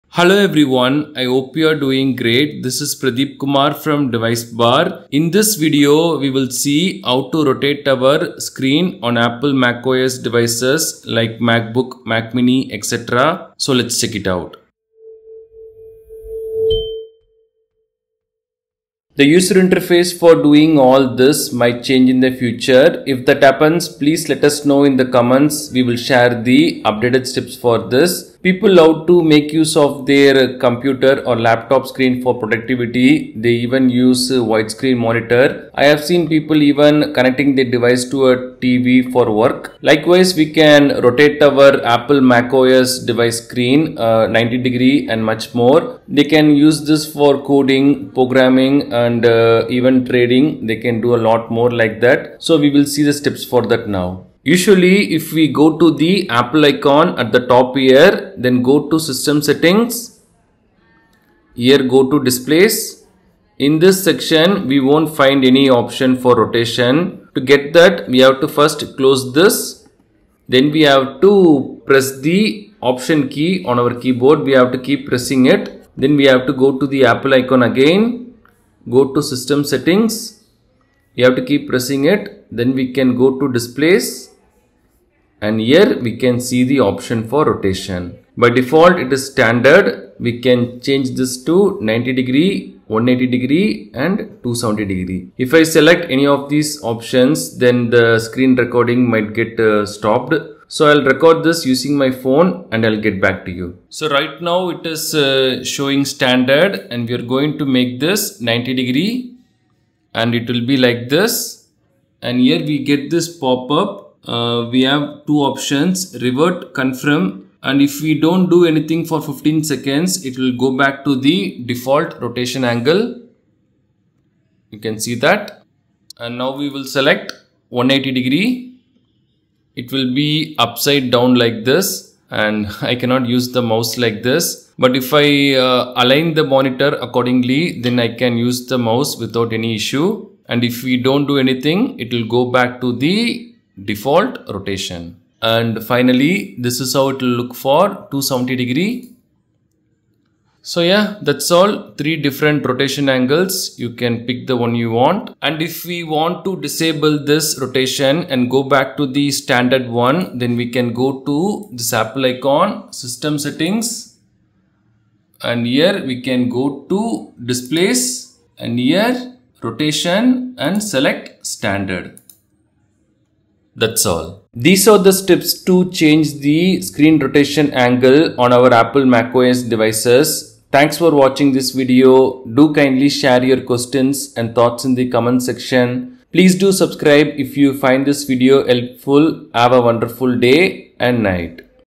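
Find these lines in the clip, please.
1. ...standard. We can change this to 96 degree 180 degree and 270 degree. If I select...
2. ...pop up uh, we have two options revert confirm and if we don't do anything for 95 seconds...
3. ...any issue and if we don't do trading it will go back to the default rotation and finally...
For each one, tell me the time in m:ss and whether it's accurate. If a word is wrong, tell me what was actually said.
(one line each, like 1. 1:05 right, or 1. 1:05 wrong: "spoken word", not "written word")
1. 1:29 wrong: "90", not "96"
2. 1:53 wrong: "15", not "95"
3. 2:19 wrong: "anything", not "trading".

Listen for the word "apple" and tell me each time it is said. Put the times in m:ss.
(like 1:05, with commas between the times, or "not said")
0:09, 0:41, 0:56, 1:17, 2:41, 2:58.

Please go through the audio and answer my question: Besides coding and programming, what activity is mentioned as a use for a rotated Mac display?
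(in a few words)
Trading.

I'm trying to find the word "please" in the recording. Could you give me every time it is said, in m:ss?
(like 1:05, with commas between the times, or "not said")
0:23, 3:06.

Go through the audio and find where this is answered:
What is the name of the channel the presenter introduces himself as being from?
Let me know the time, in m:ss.
0:04.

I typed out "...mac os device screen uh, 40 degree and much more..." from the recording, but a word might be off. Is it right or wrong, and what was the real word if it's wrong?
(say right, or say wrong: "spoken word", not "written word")
wrong: "90", not "40".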